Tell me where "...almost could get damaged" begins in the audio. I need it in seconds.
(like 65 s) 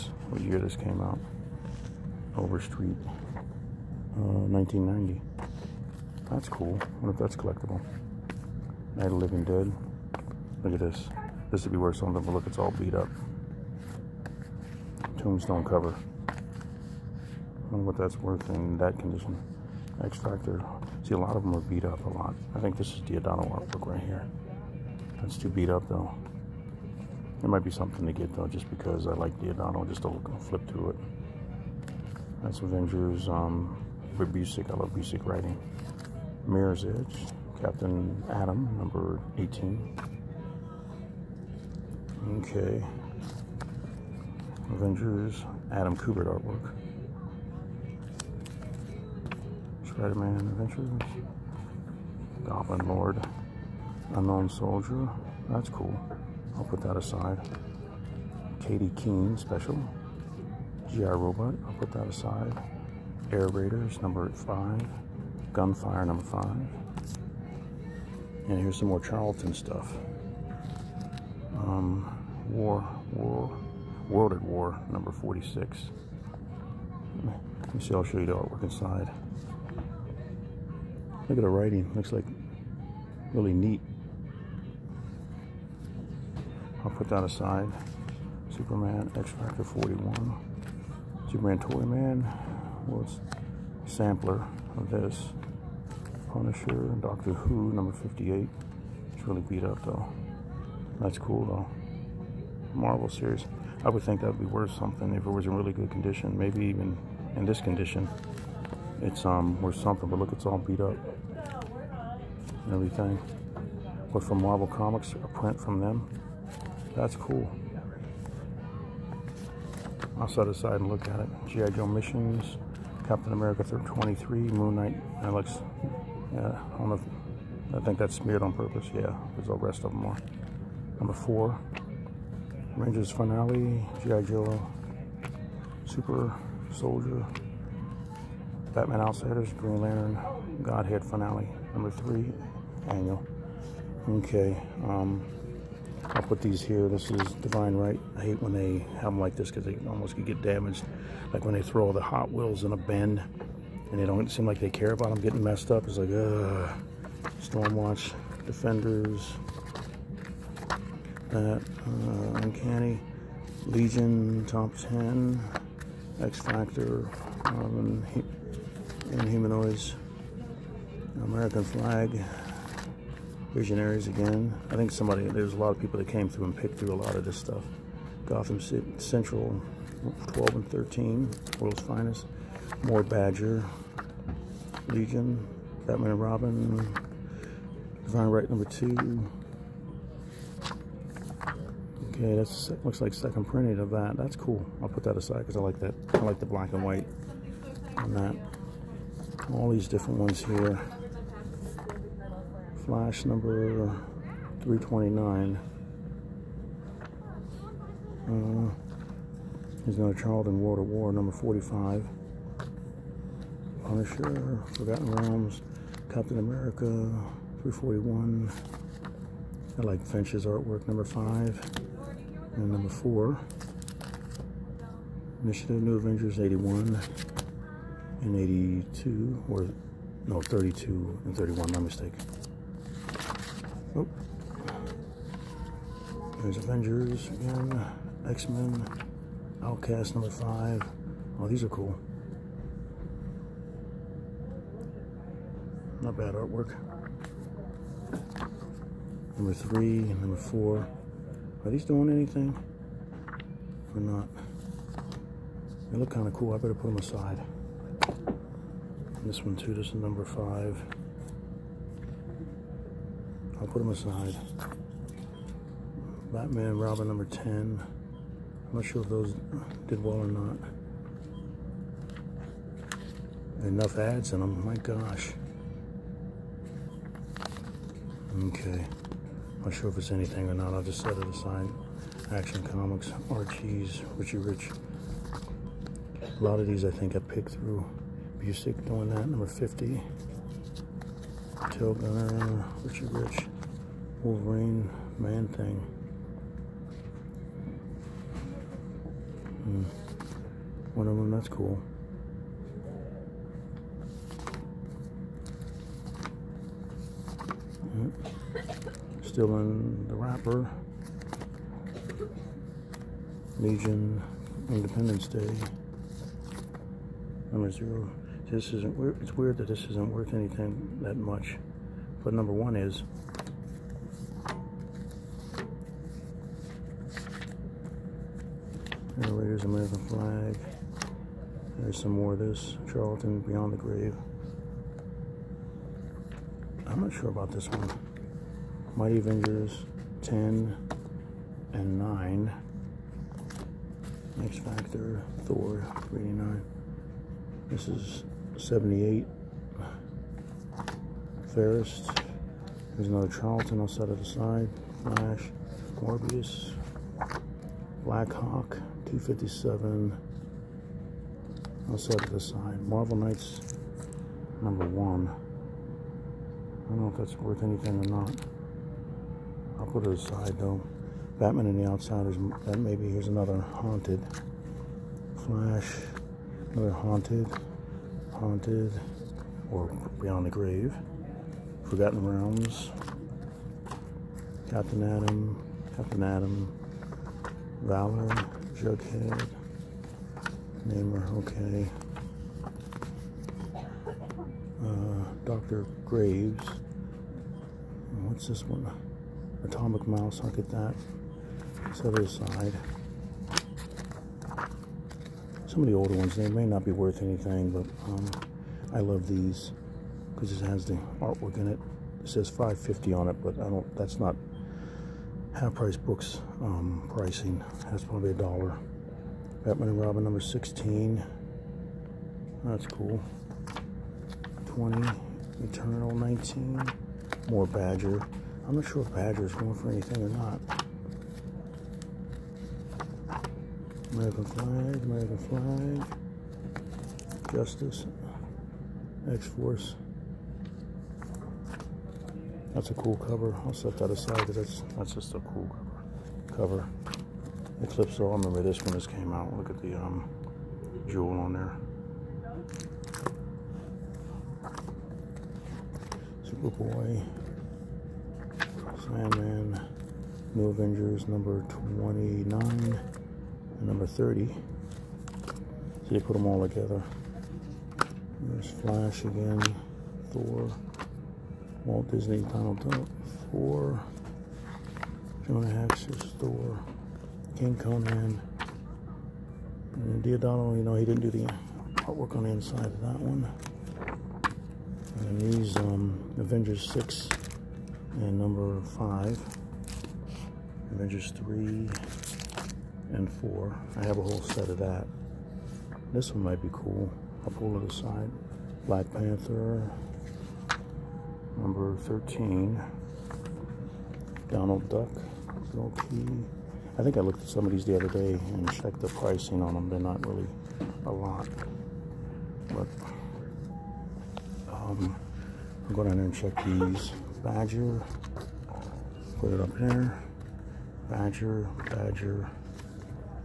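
149 s.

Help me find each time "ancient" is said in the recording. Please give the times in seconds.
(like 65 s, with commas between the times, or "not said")
not said.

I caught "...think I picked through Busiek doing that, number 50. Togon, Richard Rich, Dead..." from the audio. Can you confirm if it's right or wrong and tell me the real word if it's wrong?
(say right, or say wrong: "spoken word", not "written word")
wrong: "Wolverine", not "Dead".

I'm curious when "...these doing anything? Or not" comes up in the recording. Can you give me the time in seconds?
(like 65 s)
251 s.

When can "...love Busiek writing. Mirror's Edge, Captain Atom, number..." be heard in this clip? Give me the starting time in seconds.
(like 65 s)
34 s.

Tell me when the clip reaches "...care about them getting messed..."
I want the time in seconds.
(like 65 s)
154 s.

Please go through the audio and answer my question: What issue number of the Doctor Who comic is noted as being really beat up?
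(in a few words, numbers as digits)
58.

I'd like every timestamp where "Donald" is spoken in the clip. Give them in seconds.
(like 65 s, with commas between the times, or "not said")
472 s, 504 s.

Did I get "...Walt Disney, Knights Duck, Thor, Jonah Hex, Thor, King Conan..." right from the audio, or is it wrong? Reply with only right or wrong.
wrong.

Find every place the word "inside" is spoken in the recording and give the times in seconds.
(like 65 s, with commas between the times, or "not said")
78 s, 482 s.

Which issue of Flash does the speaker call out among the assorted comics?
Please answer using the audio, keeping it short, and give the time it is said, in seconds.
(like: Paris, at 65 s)
329, at 202 s.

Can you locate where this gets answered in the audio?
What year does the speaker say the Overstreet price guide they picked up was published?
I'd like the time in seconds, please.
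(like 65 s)
4 s.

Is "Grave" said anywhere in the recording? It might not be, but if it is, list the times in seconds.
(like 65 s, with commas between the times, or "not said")
333 s, 380 s, 396 s.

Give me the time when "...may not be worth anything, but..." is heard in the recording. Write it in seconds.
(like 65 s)
406 s.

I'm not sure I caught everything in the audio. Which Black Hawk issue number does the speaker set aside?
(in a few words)
257.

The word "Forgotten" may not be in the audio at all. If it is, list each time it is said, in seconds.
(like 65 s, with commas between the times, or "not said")
214 s, 381 s.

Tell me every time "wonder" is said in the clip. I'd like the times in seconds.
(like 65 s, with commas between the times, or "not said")
7 s, 17 s.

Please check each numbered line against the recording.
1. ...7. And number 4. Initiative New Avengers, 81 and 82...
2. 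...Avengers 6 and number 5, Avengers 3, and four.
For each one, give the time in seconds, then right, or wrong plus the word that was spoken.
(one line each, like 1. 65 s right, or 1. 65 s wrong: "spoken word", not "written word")
1. 221 s wrong: "5", not "7"
2. 486 s right.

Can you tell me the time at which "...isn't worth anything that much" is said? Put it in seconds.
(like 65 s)
319 s.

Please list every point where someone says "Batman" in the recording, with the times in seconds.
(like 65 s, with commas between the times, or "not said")
138 s, 185 s, 266 s, 371 s, 419 s.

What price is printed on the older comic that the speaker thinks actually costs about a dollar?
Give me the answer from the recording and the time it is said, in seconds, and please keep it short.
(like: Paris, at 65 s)
550, at 412 s.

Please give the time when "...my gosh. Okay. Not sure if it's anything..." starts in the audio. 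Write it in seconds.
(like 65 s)
274 s.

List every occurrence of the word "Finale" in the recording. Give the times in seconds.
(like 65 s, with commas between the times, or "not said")
133 s, 141 s.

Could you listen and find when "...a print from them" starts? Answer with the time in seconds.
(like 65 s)
115 s.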